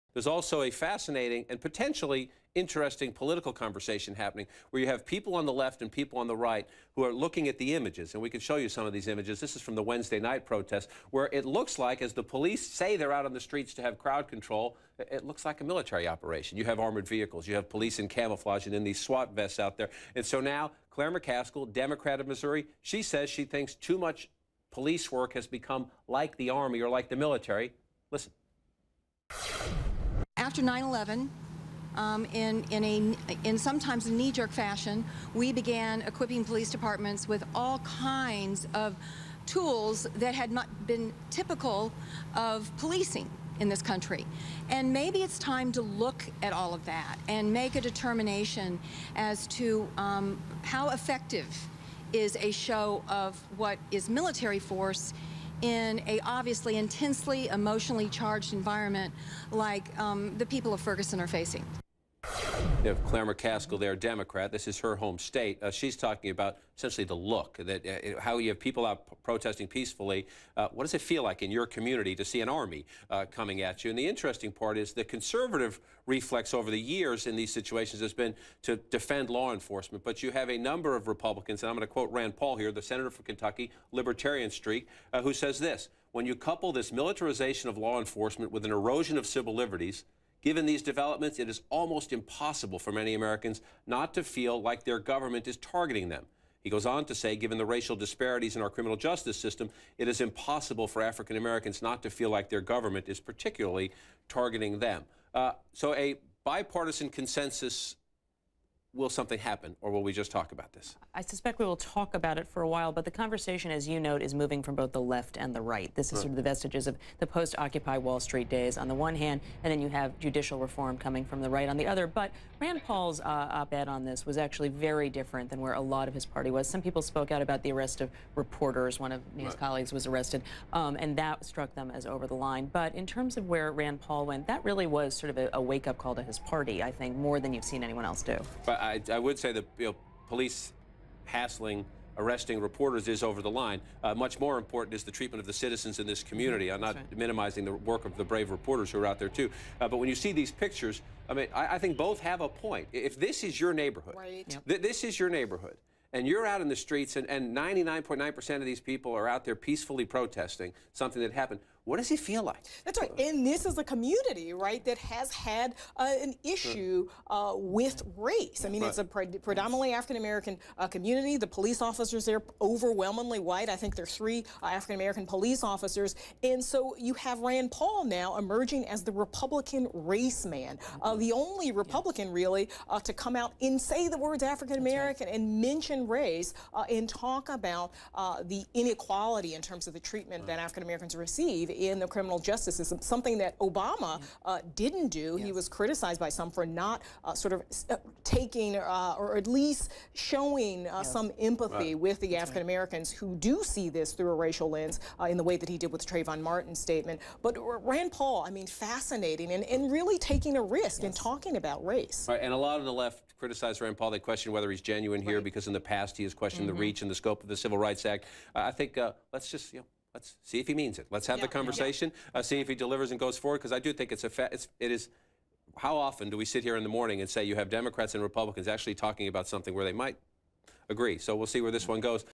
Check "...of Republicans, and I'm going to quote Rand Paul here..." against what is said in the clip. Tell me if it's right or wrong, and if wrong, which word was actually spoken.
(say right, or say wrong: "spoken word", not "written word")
right.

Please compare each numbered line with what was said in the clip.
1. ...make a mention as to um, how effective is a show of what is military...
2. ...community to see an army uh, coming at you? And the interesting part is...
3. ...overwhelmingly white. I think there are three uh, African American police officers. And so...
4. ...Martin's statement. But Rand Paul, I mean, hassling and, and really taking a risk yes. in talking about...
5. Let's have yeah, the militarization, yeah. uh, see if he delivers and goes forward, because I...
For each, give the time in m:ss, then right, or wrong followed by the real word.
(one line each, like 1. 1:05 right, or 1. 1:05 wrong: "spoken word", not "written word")
1. 0:47 wrong: "determination", not "mention"
2. 1:11 right
3. 2:52 right
4. 3:26 wrong: "fascinating", not "hassling"
5. 3:41 wrong: "conversation", not "militarization".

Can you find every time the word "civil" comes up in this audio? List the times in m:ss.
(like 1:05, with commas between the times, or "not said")
1:29, 3:37.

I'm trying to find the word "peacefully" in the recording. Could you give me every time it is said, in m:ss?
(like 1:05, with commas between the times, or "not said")
1:09, 2:39.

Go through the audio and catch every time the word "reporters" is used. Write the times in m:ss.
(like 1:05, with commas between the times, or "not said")
2:08, 2:22, 2:28.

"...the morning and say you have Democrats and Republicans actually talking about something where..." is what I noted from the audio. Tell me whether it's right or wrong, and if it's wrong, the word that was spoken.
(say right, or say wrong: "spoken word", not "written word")
right.